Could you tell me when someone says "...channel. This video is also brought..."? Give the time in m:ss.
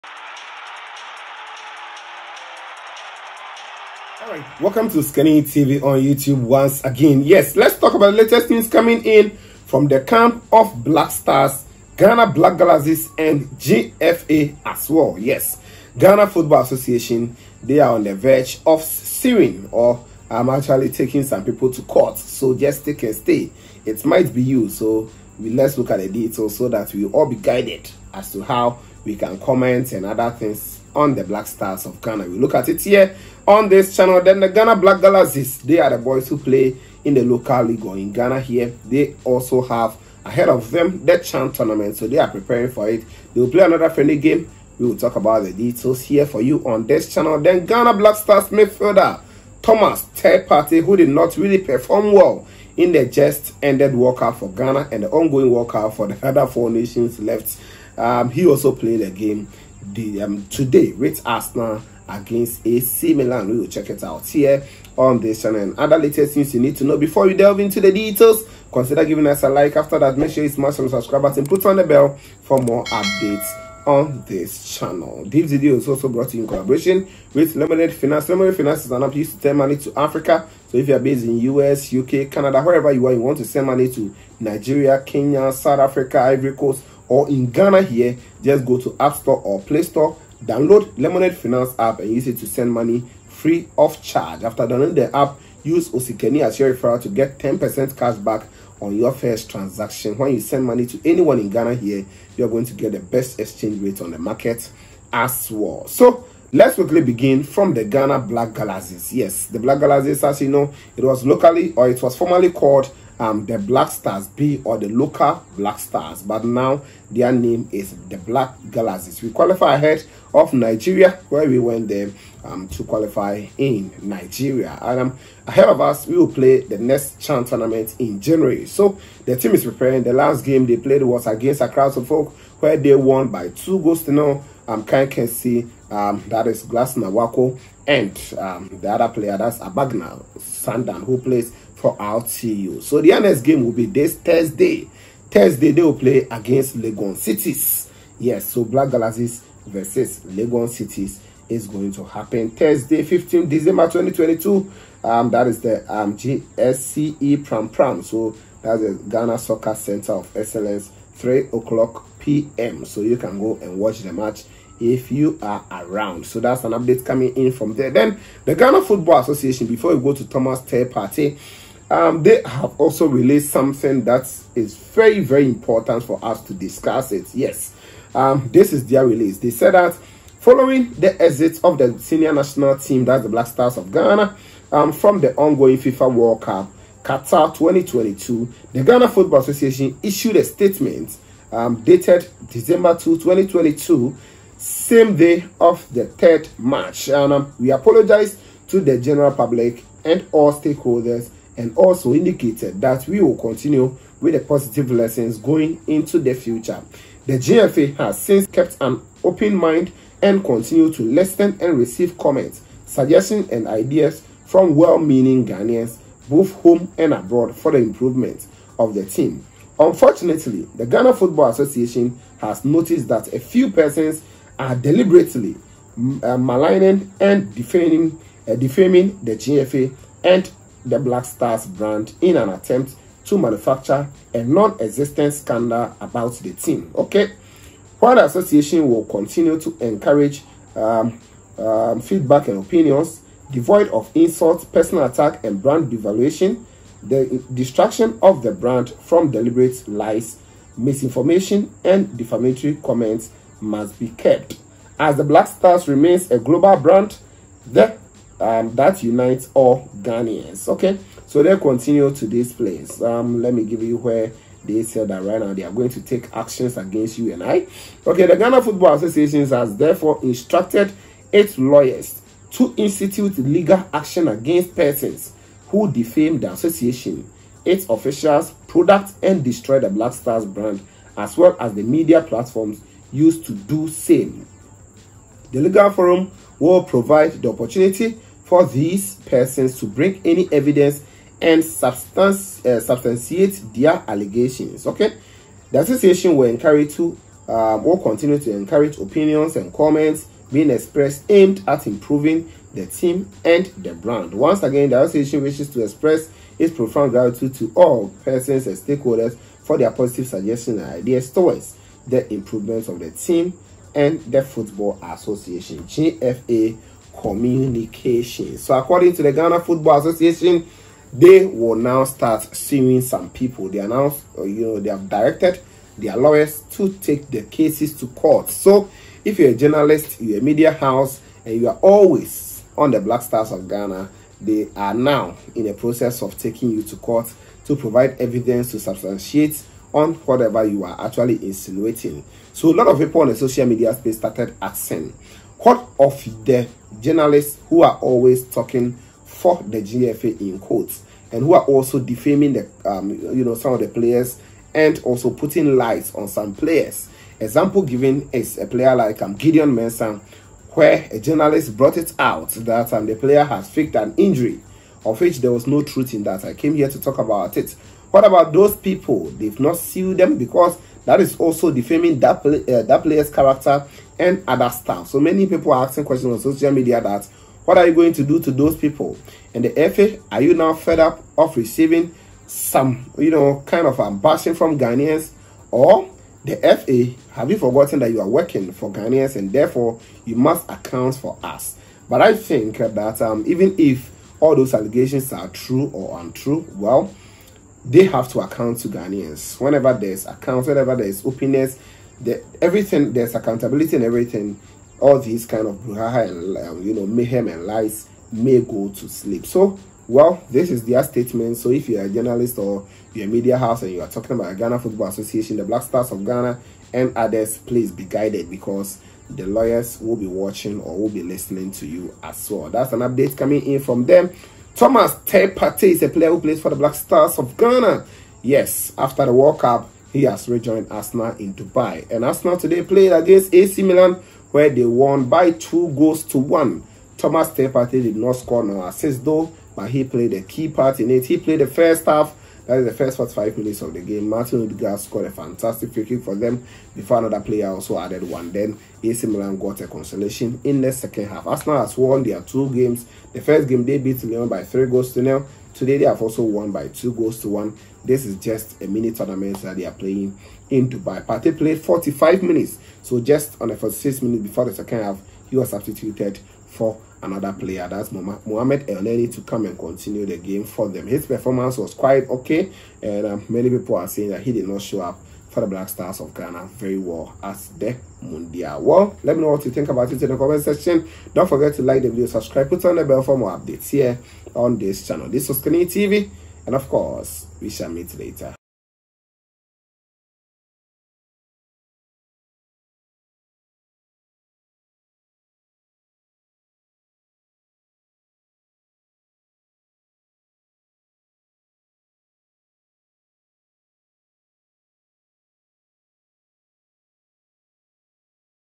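1:14.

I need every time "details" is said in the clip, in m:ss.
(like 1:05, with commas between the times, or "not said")
0:26, 0:45, 1:07.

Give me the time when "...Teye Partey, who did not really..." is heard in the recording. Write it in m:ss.
0:50.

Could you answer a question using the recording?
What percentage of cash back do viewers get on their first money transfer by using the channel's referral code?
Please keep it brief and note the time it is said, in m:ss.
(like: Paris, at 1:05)
10%, at 1:37.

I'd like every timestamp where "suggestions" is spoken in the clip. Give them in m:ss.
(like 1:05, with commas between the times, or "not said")
3:32, 5:10.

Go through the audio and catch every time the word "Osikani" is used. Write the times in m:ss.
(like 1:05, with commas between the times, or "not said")
0:04, 1:35, 8:05.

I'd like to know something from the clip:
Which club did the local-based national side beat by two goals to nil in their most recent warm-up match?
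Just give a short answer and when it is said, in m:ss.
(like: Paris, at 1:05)
Accra Folk, at 2:11.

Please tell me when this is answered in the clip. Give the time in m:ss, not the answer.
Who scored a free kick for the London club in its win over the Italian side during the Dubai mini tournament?
7:24.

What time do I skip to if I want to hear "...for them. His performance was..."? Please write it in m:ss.
7:50.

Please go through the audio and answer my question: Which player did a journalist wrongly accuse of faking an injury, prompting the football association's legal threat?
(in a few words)
Gideon Mensah.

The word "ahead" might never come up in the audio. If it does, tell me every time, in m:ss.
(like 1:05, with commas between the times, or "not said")
0:40, 1:59, 2:05.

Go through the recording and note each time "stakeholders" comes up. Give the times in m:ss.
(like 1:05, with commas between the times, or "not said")
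3:20, 5:08.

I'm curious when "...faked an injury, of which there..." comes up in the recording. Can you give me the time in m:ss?
6:03.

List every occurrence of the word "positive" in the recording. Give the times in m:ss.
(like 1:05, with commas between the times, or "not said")
3:24, 5:09.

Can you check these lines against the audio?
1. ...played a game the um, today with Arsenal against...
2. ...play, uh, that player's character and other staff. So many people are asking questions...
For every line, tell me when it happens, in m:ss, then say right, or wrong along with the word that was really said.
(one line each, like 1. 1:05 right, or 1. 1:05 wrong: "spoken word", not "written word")
1. 0:58 right
2. 6:12 right.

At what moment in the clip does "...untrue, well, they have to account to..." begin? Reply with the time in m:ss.
6:36.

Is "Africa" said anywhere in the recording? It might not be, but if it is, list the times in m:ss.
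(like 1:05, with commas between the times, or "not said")
1:19, 1:25.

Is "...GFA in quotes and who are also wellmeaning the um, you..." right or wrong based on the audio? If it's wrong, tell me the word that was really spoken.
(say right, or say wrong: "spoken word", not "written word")
wrong: "defaming", not "wellmeaning".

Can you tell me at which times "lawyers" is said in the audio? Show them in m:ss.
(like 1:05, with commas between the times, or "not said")
4:31, 5:26, 6:59.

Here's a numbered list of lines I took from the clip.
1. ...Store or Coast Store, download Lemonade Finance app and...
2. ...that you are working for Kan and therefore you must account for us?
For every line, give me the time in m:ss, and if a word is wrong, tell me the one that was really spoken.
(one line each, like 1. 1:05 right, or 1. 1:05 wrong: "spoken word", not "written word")
1. 1:29 wrong: "Play", not "Coast"
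2. 6:27 wrong: "Ghanaians", not "Kan".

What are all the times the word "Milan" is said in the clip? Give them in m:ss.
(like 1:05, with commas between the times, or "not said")
1:03, 7:13, 7:29.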